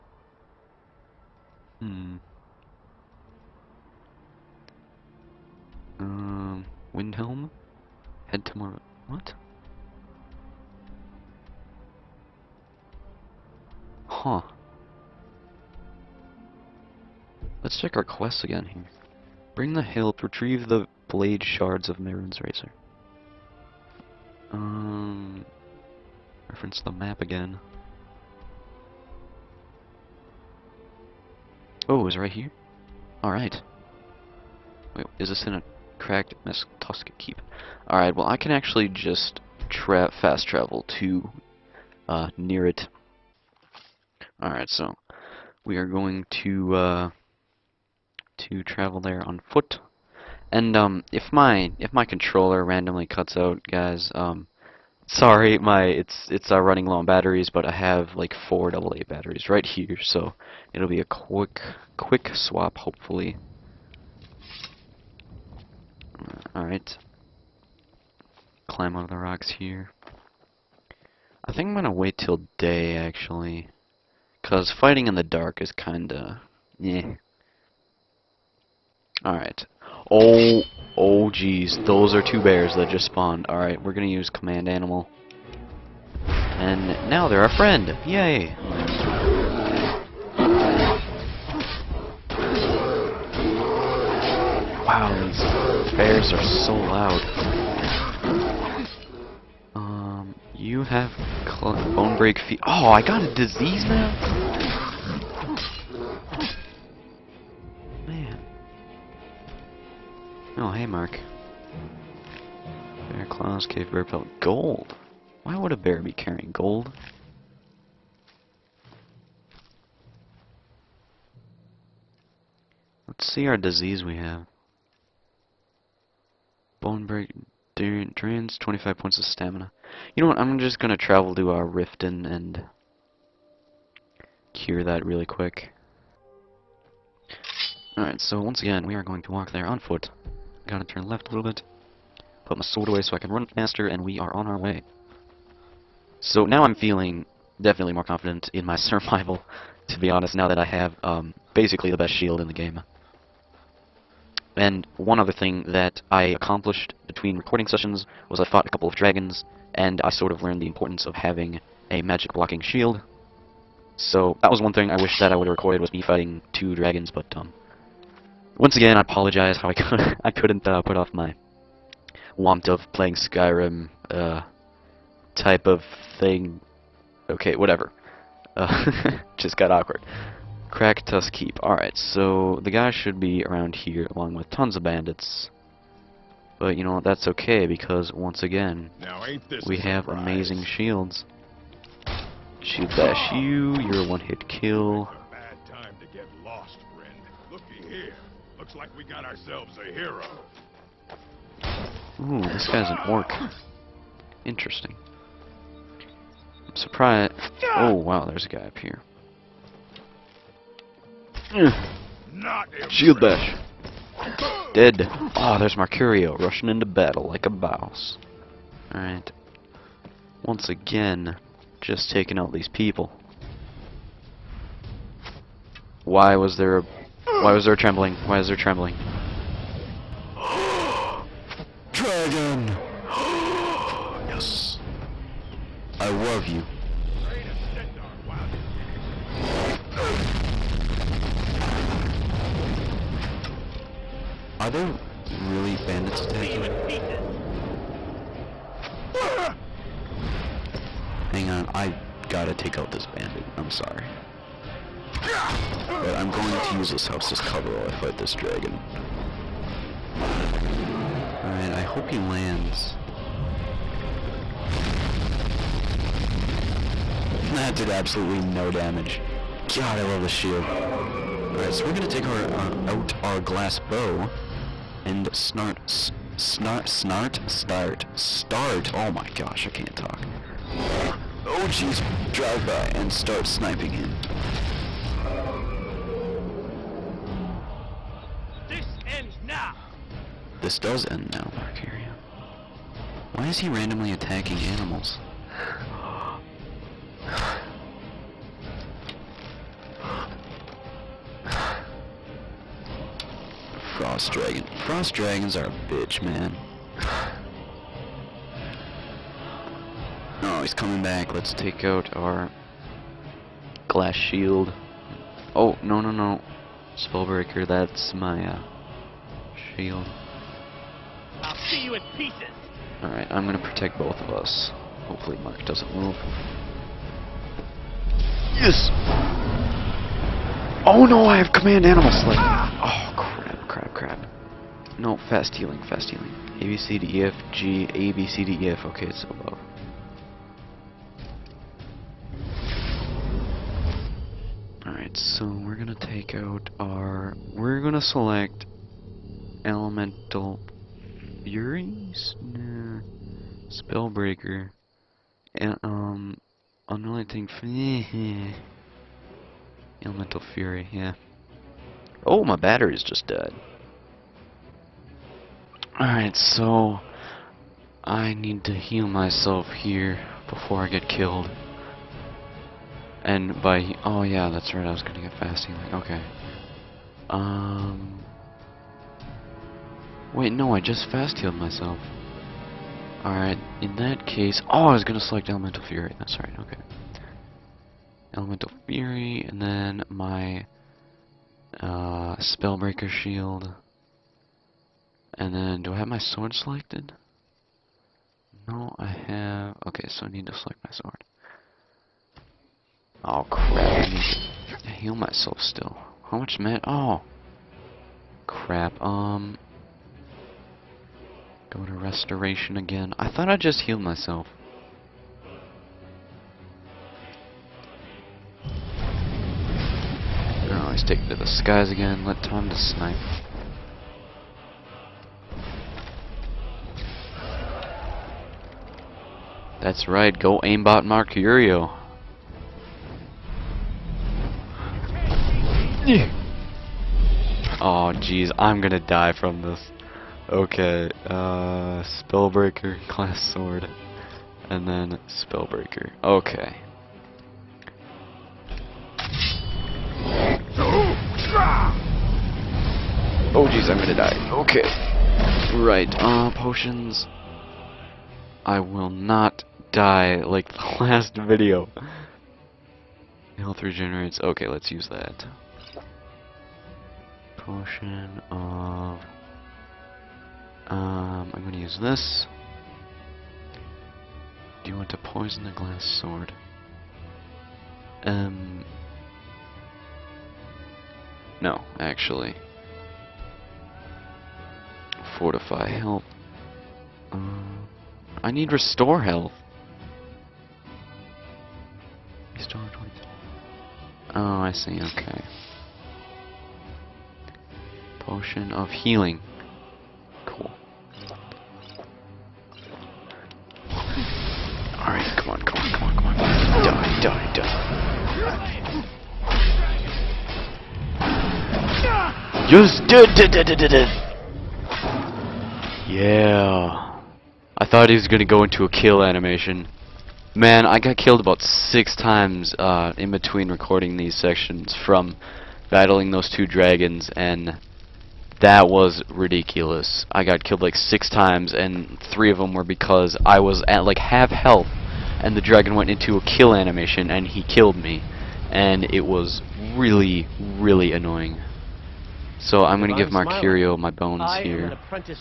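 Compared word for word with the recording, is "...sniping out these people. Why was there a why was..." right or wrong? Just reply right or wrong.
wrong.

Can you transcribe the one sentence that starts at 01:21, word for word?
Those are two bears that just spawned.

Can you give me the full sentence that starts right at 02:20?
Gotta turn left a little bit.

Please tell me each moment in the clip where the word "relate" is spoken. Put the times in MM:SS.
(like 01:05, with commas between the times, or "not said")
not said.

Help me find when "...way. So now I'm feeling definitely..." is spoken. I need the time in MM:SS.
02:24.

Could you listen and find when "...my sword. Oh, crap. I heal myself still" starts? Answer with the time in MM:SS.
06:40.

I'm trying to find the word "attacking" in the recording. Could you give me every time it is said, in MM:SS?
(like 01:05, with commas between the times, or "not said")
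04:06, 04:54.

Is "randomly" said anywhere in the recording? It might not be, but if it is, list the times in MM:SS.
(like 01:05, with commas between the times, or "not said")
00:52, 04:53.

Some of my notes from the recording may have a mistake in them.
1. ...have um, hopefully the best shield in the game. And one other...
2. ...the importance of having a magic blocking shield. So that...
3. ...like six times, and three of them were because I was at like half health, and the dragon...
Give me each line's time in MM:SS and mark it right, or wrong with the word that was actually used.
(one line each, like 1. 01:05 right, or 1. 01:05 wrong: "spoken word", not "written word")
1. 02:30 wrong: "basically", not "hopefully"
2. 02:40 right
3. 08:50 right.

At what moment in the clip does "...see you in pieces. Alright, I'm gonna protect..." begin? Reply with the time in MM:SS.
05:21.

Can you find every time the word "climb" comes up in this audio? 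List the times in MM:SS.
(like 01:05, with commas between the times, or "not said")
01:08.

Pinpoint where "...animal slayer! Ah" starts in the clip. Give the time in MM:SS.
05:31.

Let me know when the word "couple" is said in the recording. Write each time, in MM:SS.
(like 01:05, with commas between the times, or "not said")
02:38.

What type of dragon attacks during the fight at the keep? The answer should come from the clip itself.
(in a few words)
Frost Dragon.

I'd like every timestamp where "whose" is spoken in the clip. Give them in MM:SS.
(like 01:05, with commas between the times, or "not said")
not said.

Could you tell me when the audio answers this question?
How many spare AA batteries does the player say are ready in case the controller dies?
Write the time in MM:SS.
00:58.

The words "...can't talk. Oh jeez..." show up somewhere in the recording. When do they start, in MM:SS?
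04:39.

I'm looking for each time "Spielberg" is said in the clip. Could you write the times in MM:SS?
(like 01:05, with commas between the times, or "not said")
not said.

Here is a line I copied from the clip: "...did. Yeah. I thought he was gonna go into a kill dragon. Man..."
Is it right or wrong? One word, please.
wrong.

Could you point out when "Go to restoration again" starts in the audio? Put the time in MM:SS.
06:51.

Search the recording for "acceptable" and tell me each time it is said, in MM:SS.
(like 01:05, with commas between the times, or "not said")
not said.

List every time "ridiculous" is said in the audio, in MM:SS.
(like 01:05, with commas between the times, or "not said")
08:49.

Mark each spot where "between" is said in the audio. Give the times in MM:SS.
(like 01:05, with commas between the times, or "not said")
02:37, 08:43.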